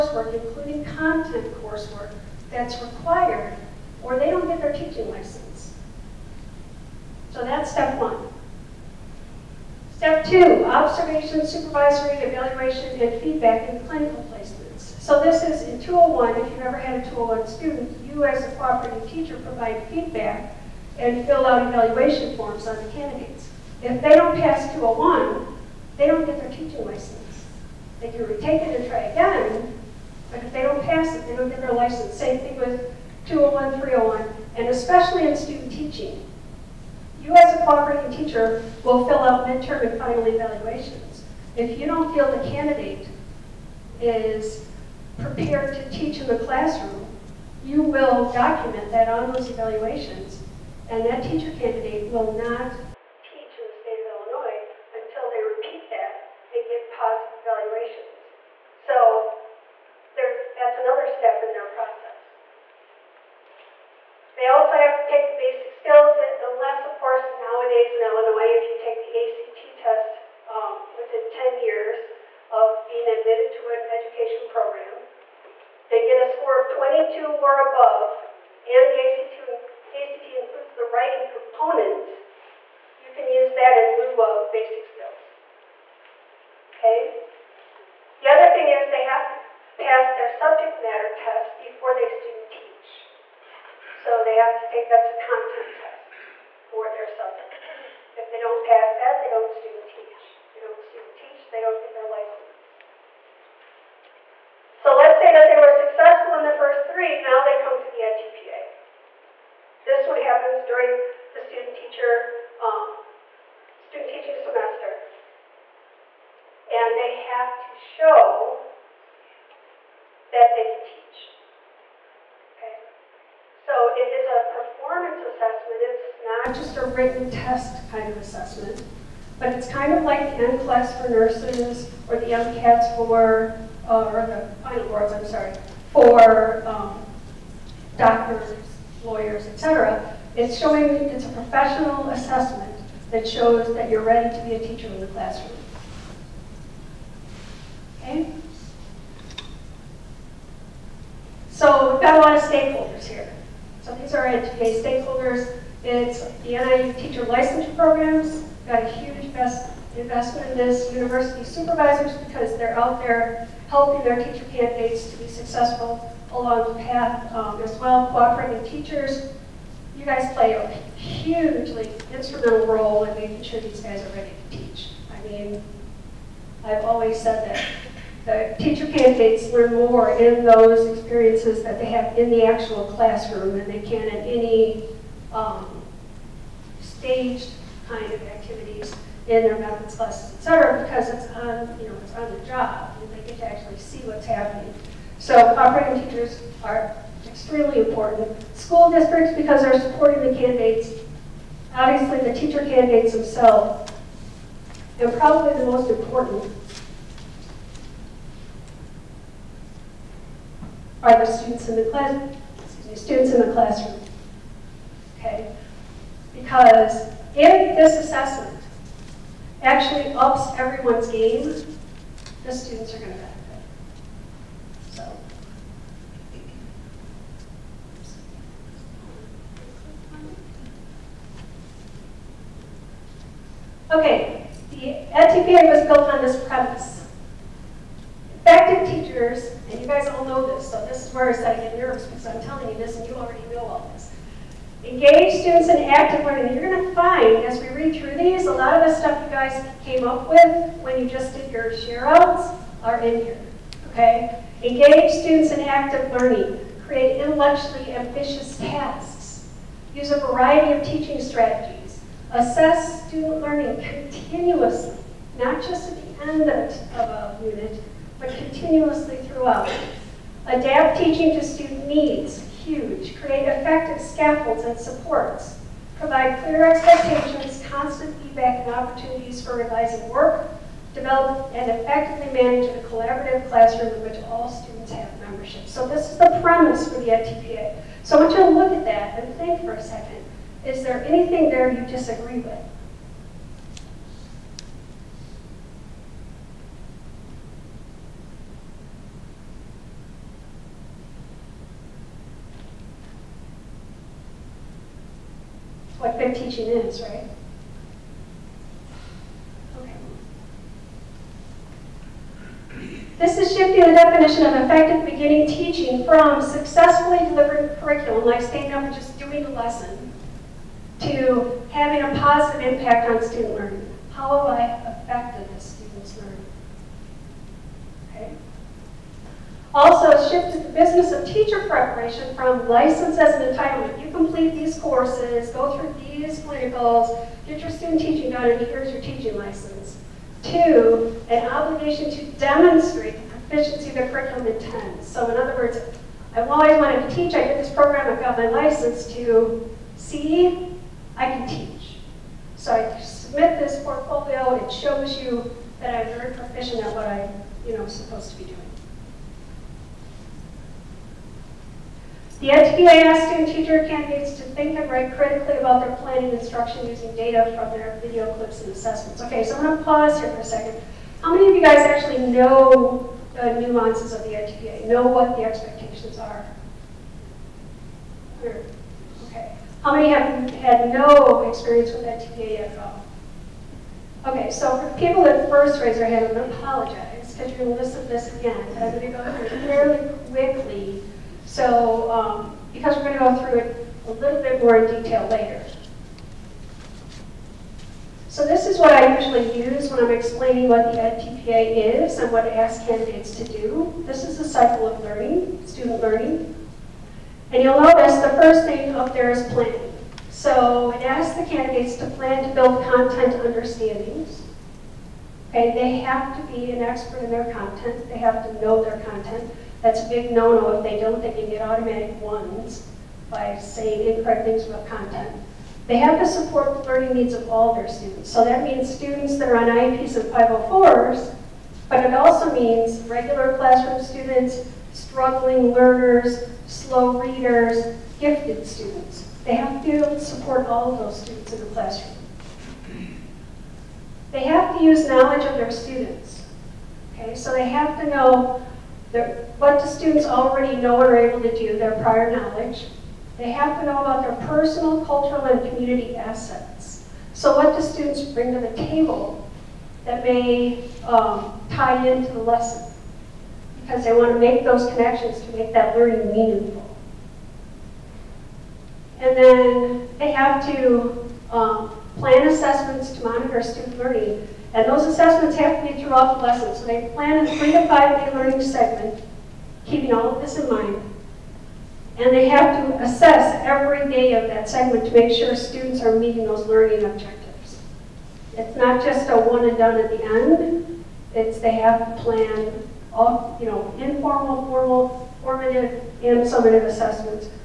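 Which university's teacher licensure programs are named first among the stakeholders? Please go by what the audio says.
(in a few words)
NIU.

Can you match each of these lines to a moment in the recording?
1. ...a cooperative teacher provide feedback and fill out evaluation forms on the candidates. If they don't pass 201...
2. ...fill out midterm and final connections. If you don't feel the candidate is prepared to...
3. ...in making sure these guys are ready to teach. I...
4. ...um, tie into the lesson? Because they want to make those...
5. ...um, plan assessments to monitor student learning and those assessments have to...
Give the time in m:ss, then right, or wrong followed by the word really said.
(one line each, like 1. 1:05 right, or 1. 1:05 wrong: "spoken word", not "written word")
1. 0:18 right
2. 0:39 wrong: "evaluations", not "connections"
3. 2:53 right
4. 7:41 right
5. 7:51 right.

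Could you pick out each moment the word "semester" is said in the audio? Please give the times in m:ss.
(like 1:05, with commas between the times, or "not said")
1:54.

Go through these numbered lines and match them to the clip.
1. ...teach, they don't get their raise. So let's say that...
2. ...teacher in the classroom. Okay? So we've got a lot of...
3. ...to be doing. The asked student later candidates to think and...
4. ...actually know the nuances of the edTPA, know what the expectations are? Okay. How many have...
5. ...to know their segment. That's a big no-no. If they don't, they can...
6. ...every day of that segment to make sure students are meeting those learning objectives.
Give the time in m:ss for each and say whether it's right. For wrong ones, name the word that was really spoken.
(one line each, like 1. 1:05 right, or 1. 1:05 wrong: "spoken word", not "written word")
1. 1:41 wrong: "license", not "raise"
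2. 2:24 right
3. 5:58 wrong: "teacher", not "later"
4. 6:11 right
5. 6:58 wrong: "content", not "segment"
6. 8:03 right.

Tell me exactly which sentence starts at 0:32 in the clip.
Same thing with 201, 301, and especially in student teaching.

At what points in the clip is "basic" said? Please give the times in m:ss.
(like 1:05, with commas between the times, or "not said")
1:05, 1:24.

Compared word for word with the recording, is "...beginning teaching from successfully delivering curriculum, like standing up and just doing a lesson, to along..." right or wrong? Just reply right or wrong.
wrong.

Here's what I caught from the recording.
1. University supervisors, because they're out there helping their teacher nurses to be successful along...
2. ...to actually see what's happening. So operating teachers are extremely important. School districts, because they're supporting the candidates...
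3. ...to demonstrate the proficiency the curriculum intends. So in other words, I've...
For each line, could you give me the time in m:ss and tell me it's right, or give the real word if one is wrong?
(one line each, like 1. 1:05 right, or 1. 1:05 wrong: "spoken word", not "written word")
1. 2:40 wrong: "candidates", not "nurses"
2. 3:13 right
3. 5:42 right.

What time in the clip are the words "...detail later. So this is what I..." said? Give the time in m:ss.
6:35.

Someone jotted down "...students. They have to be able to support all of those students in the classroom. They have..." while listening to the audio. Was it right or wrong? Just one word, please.
right.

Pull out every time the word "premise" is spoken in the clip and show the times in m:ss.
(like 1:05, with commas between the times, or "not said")
3:56, 4:46.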